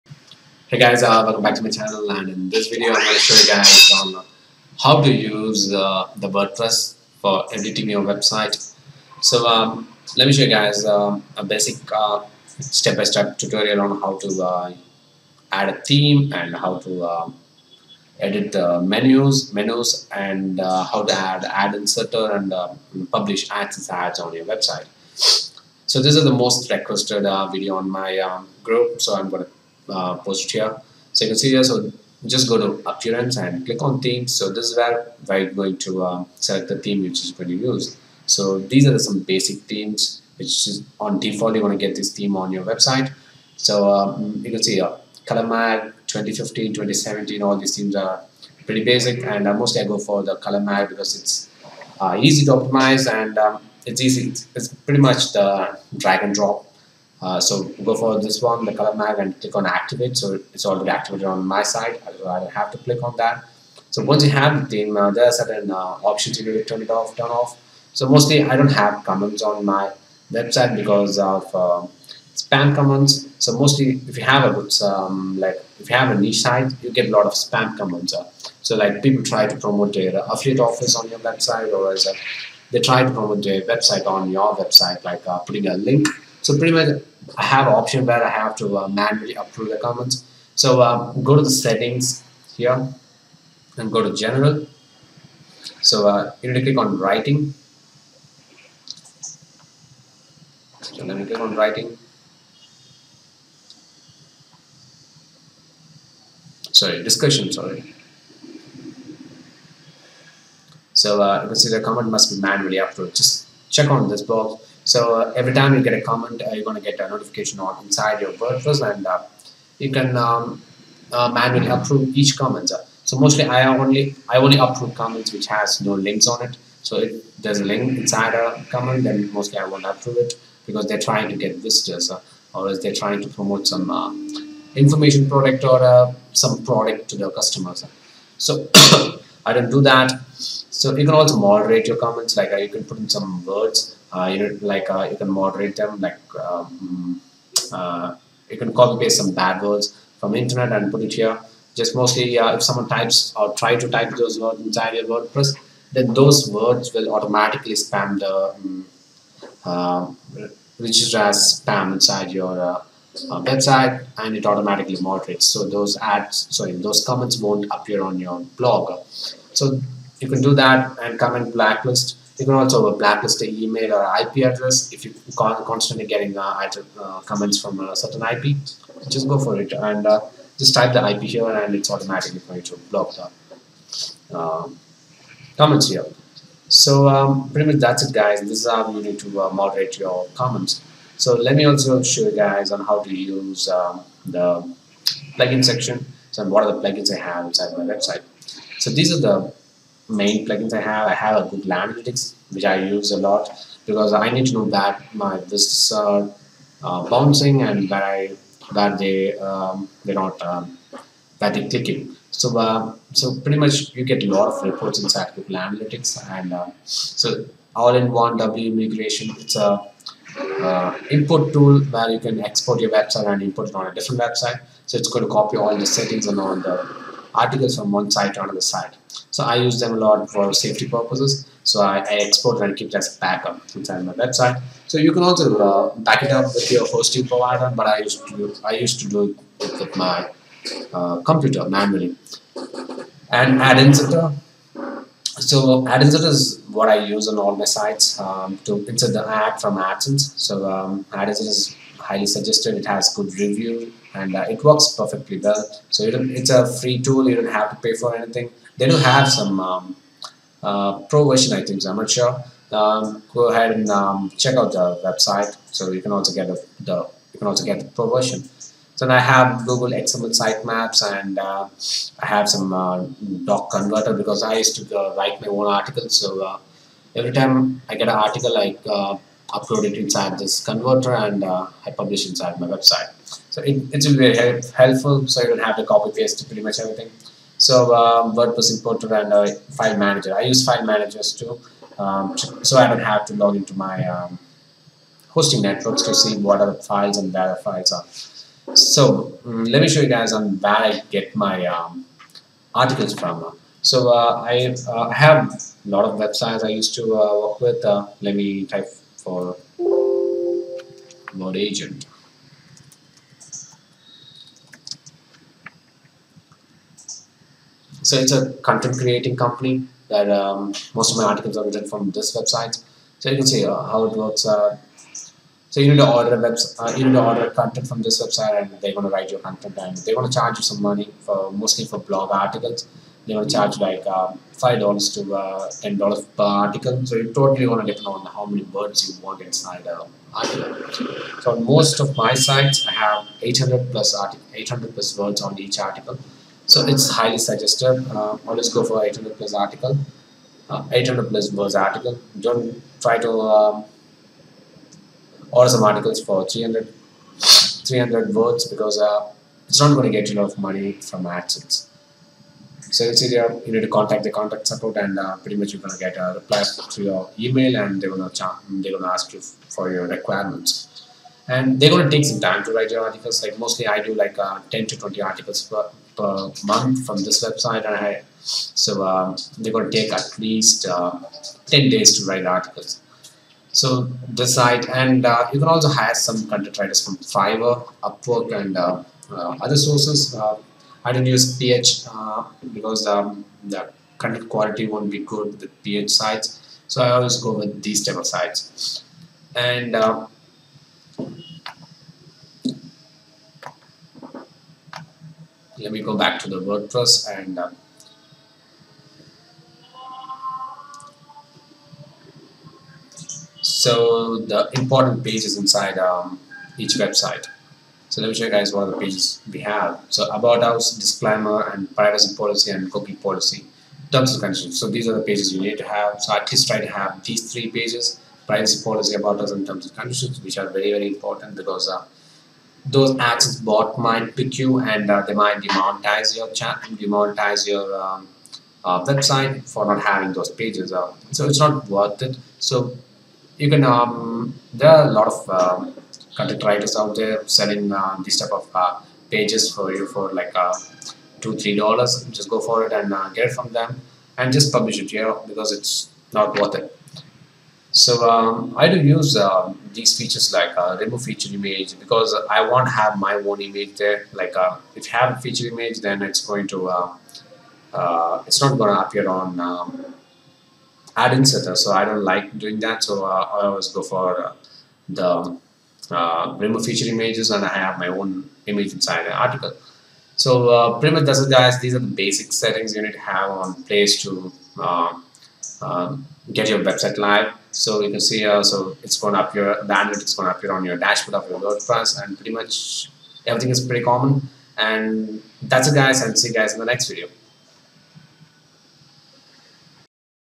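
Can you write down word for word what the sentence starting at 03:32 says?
So uh, so pretty much you get a lot of reports inside Google Analytics and uh, so all-in-one WP Migration.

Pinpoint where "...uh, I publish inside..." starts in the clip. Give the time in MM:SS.
04:41.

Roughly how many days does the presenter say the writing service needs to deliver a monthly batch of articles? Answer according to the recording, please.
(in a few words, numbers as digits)
10 days.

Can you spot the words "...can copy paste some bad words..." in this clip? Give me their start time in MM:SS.
02:28.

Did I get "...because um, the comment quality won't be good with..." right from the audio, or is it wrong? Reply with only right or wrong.
wrong.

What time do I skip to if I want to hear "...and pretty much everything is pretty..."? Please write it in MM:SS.
08:12.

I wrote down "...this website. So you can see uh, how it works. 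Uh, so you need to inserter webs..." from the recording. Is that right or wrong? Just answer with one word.
wrong.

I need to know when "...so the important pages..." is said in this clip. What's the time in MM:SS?
06:53.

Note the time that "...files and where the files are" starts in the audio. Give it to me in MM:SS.
04:56.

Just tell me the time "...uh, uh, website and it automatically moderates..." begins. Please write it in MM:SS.
02:42.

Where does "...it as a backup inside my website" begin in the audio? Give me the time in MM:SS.
03:52.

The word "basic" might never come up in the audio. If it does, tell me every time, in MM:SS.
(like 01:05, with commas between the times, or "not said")
00:11, 00:39, 00:48, 08:02.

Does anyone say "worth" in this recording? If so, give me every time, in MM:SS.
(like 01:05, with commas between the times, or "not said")
07:21, 07:36.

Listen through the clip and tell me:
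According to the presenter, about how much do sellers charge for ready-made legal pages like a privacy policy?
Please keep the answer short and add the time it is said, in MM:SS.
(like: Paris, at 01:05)
2-3 dollars, at 07:31.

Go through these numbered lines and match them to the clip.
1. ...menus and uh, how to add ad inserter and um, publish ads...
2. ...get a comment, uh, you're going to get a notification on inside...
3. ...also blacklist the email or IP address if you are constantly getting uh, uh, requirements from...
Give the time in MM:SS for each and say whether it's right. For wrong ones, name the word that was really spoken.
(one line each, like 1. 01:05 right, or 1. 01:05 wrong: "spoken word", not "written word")
1. 00:19 right
2. 01:55 right
3. 02:52 wrong: "comments", not "requirements".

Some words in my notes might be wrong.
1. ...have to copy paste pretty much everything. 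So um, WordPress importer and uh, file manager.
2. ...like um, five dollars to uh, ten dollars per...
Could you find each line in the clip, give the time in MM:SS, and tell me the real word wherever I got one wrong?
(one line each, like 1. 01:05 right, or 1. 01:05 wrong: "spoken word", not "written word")
1. 04:45 right
2. 05:33 right.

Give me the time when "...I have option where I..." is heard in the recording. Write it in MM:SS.
01:27.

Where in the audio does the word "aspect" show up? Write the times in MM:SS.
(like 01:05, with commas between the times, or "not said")
not said.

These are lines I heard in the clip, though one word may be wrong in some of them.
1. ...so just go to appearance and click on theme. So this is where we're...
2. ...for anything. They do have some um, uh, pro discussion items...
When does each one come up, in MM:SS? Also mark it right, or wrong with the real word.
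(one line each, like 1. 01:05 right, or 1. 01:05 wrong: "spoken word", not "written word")
1. 00:31 right
2. 04:17 wrong: "version", not "discussion".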